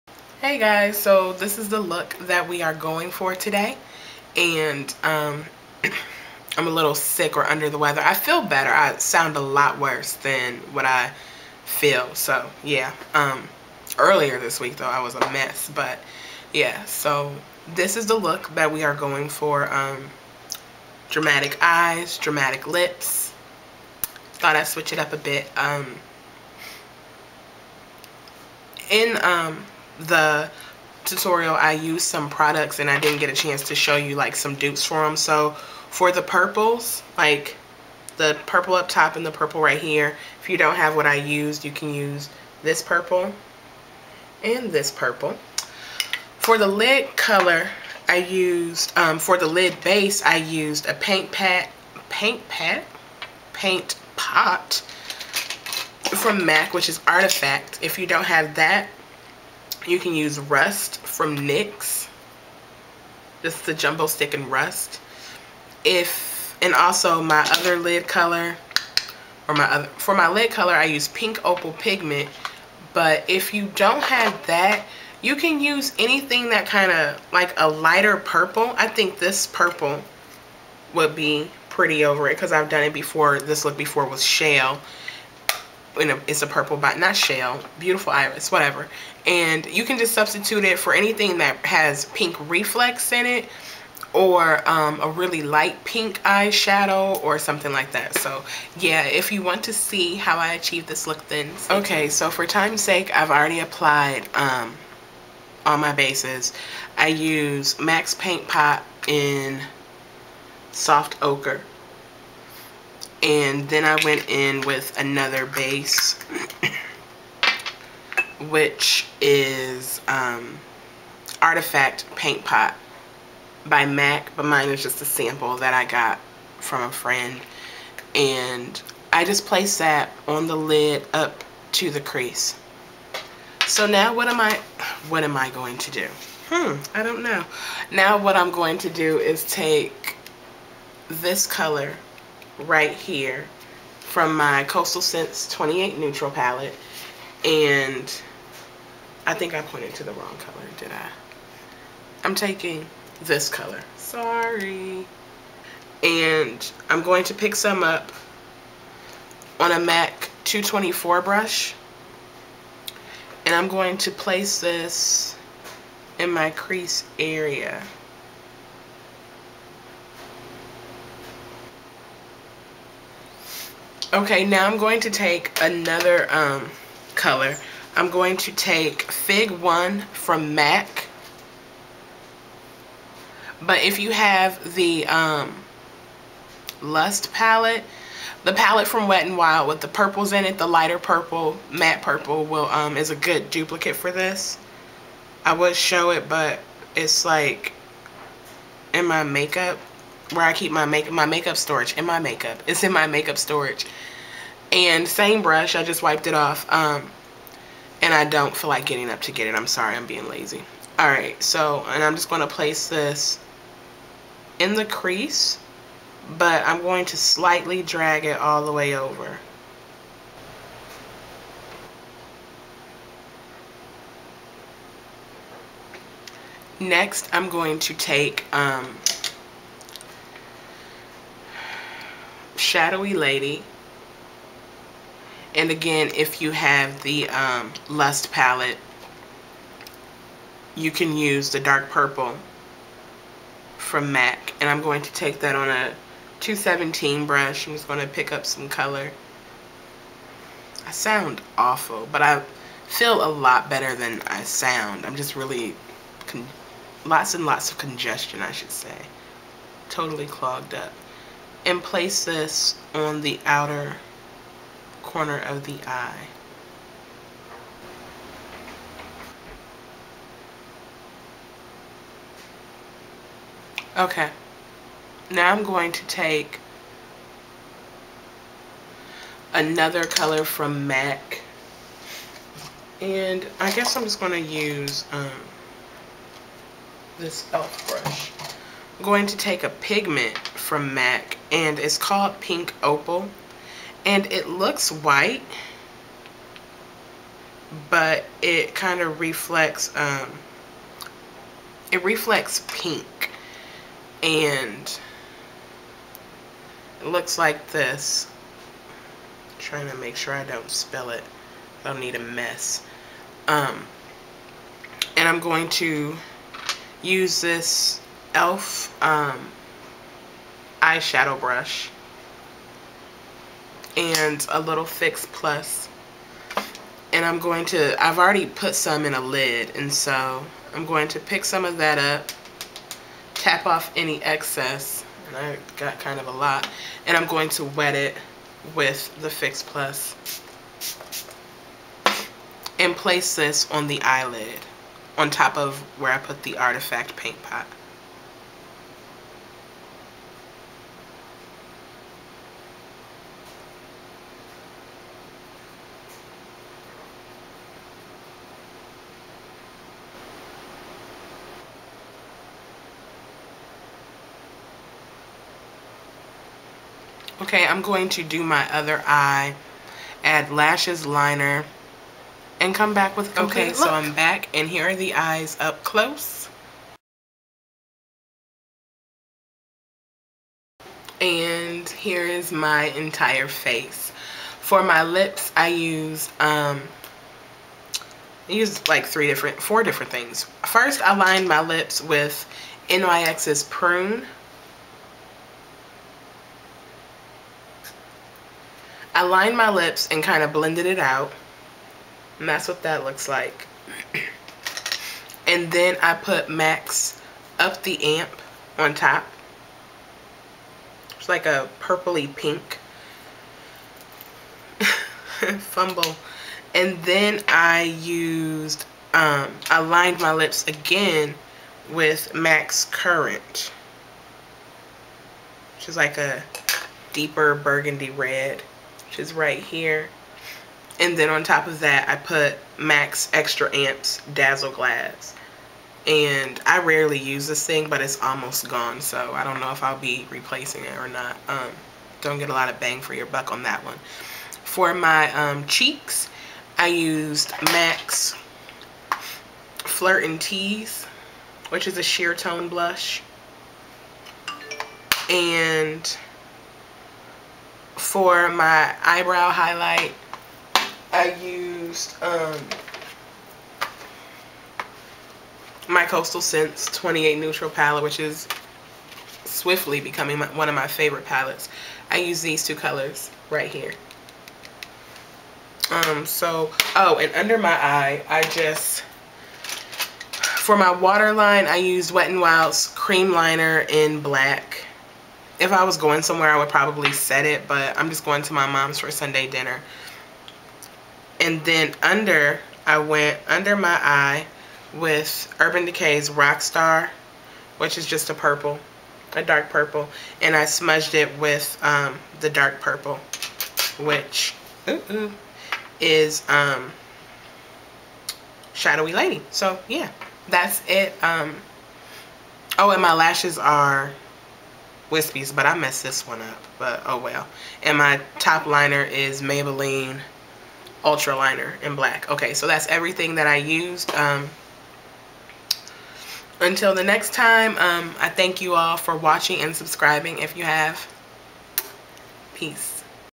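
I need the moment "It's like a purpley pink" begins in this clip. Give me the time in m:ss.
6:51.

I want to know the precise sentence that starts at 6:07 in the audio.
Okay, I'm going to do my other eye, add lashes, liner, and come back with Okay, look.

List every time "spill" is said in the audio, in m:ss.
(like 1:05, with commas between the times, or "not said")
5:10.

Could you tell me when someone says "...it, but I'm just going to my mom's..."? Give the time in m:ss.
8:07.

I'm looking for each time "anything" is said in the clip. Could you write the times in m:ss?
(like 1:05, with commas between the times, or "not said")
1:15, 1:30.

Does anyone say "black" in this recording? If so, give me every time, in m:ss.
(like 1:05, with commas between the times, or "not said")
8:04, 8:41.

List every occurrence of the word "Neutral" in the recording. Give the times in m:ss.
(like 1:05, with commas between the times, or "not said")
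2:25, 7:47.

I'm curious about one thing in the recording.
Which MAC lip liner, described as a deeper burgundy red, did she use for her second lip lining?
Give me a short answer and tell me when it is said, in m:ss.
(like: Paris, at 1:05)
Currant, at 7:02.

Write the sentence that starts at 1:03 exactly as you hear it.
Just the Jumbo Stick and Rust.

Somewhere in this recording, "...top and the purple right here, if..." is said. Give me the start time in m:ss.
0:38.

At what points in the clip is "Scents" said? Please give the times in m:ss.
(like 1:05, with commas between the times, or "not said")
2:25, 7:46.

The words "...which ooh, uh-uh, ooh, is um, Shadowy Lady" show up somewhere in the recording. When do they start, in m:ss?
8:23.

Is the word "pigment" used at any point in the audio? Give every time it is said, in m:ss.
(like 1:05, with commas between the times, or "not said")
1:11, 4:49.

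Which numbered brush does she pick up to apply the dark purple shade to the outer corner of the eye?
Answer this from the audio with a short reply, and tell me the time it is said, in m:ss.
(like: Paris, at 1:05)
217, at 4:06.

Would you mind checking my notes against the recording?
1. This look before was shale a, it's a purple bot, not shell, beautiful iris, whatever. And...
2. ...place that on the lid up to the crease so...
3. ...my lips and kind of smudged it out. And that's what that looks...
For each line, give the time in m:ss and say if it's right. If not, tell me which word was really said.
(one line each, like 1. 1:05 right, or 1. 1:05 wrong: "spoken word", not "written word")
1. 1:23 right
2. 2:09 right
3. 6:39 wrong: "blended", not "smudged".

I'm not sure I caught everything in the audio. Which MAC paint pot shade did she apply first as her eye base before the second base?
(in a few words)
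Soft Ochre.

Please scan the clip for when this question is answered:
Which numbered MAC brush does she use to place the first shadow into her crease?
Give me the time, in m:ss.
2:40.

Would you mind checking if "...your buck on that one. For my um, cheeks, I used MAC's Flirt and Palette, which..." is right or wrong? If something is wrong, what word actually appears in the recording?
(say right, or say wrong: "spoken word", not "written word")
wrong: "Tease", not "Palette".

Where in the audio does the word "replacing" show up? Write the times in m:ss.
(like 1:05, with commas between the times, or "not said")
7:20.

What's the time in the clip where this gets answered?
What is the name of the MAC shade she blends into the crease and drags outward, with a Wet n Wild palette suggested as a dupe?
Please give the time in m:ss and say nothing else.
2:59.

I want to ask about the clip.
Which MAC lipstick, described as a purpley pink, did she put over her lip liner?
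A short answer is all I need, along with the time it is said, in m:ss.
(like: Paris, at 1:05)
Up the Amp, at 6:47.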